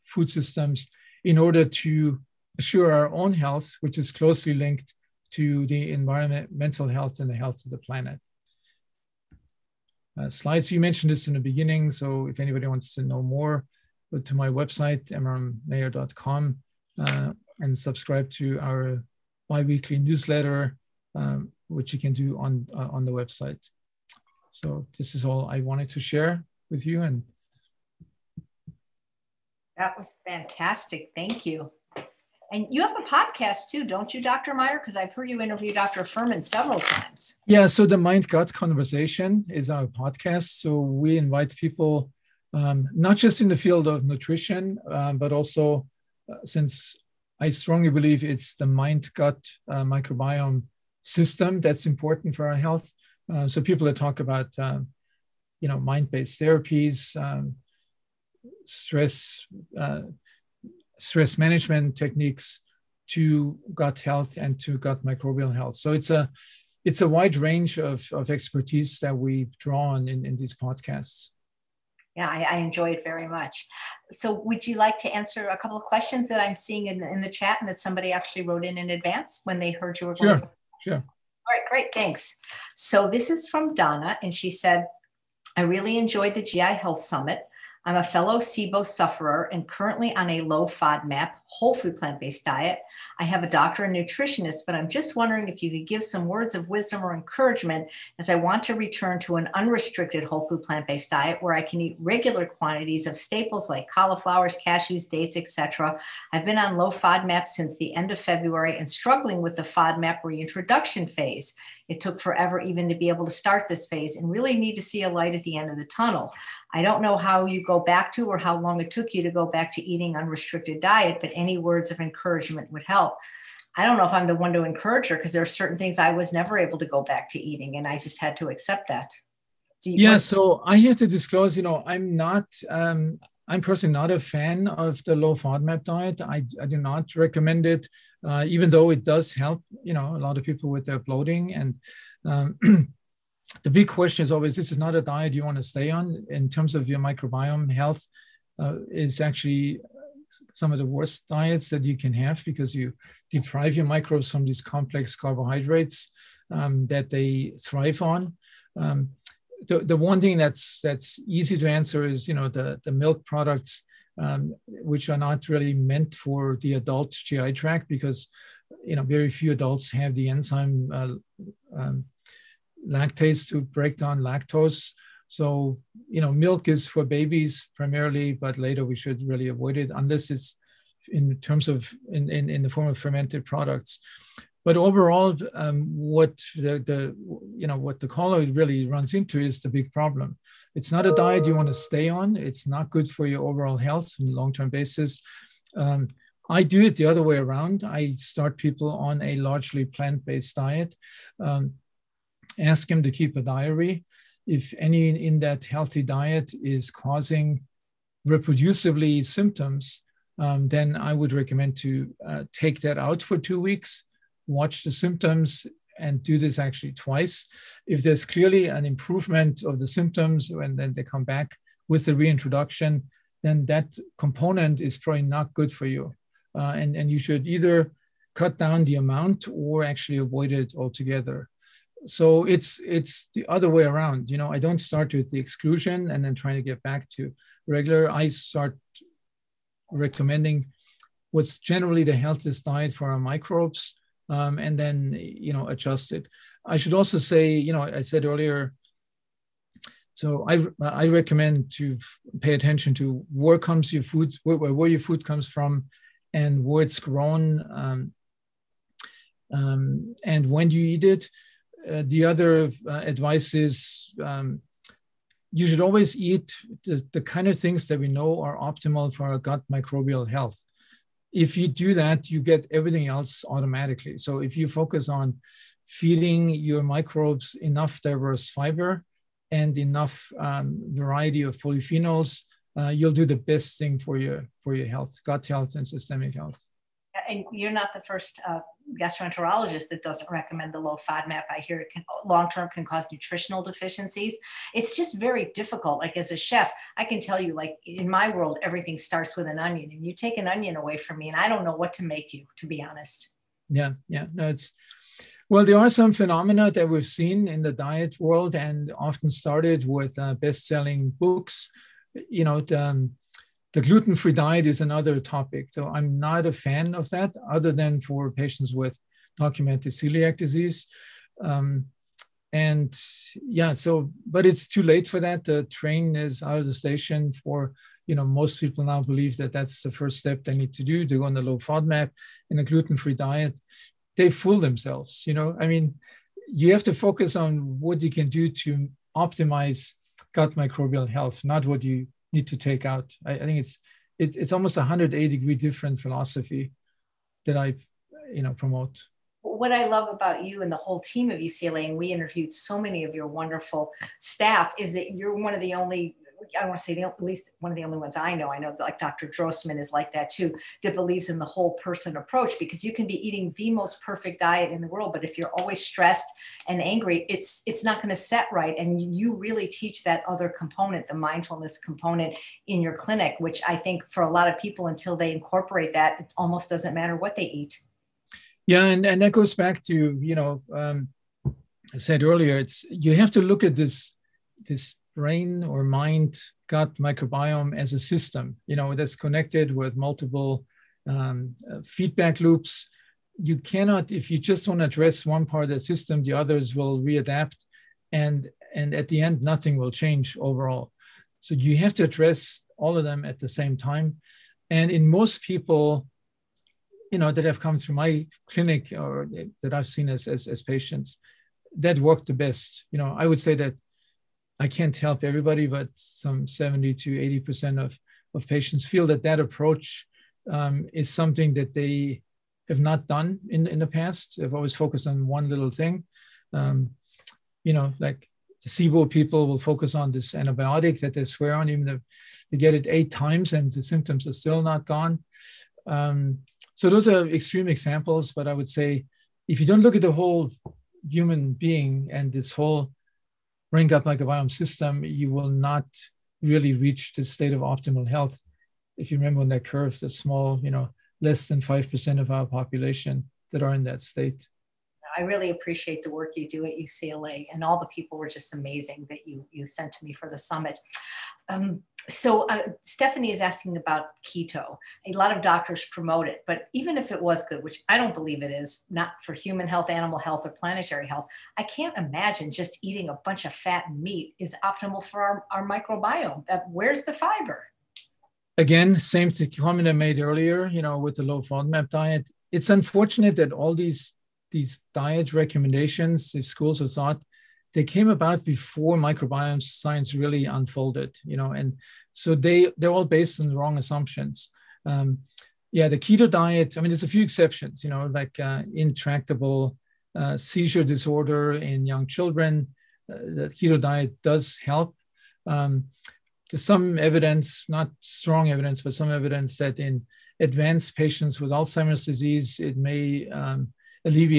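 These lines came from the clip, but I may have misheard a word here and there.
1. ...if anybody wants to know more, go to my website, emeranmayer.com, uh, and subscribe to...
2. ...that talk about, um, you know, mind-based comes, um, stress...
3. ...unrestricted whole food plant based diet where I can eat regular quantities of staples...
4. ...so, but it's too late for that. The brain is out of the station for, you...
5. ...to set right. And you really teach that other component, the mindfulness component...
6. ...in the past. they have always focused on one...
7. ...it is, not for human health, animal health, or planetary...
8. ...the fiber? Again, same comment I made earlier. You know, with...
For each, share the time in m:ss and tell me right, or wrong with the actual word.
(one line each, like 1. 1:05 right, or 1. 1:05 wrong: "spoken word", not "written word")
1. 0:12 right
2. 0:53 wrong: "therapies", not "comes"
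3. 1:39 right
4. 5:23 wrong: "train", not "brain"
5. 6:08 right
6. 7:03 right
7. 7:48 right
8. 7:57 right.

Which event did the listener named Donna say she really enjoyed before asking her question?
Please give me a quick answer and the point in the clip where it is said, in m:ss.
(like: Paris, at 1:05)
GI Health Summit, at 1:26.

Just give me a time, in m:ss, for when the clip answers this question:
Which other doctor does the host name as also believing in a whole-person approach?
5:58.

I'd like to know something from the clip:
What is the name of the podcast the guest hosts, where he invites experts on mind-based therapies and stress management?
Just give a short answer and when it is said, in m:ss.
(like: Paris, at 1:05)
Mind Gut Conversation, at 0:37.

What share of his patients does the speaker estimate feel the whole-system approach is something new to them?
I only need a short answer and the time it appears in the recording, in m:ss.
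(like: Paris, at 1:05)
70 to 80%, at 6:56.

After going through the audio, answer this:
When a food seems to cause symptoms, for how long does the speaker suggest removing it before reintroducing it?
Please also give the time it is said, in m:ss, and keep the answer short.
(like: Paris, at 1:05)
2 weeks, at 3:33.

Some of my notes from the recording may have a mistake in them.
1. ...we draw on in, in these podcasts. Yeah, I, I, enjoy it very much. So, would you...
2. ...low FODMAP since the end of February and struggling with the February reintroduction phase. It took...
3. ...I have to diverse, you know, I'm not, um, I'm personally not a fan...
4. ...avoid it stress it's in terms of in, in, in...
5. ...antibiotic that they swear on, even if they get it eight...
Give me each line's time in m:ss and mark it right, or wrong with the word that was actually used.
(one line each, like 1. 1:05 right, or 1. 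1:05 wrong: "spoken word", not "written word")
1. 1:09 right
2. 1:46 wrong: "FODMAP", not "February"
3. 2:10 wrong: "disclose", not "diverse"
4. 2:59 wrong: "unless", not "stress"
5. 7:10 right.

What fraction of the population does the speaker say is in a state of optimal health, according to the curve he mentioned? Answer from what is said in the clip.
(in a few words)
less than 5%.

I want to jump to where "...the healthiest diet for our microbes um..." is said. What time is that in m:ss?
4:02.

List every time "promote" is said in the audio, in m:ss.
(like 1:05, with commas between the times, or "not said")
5:48, 7:45.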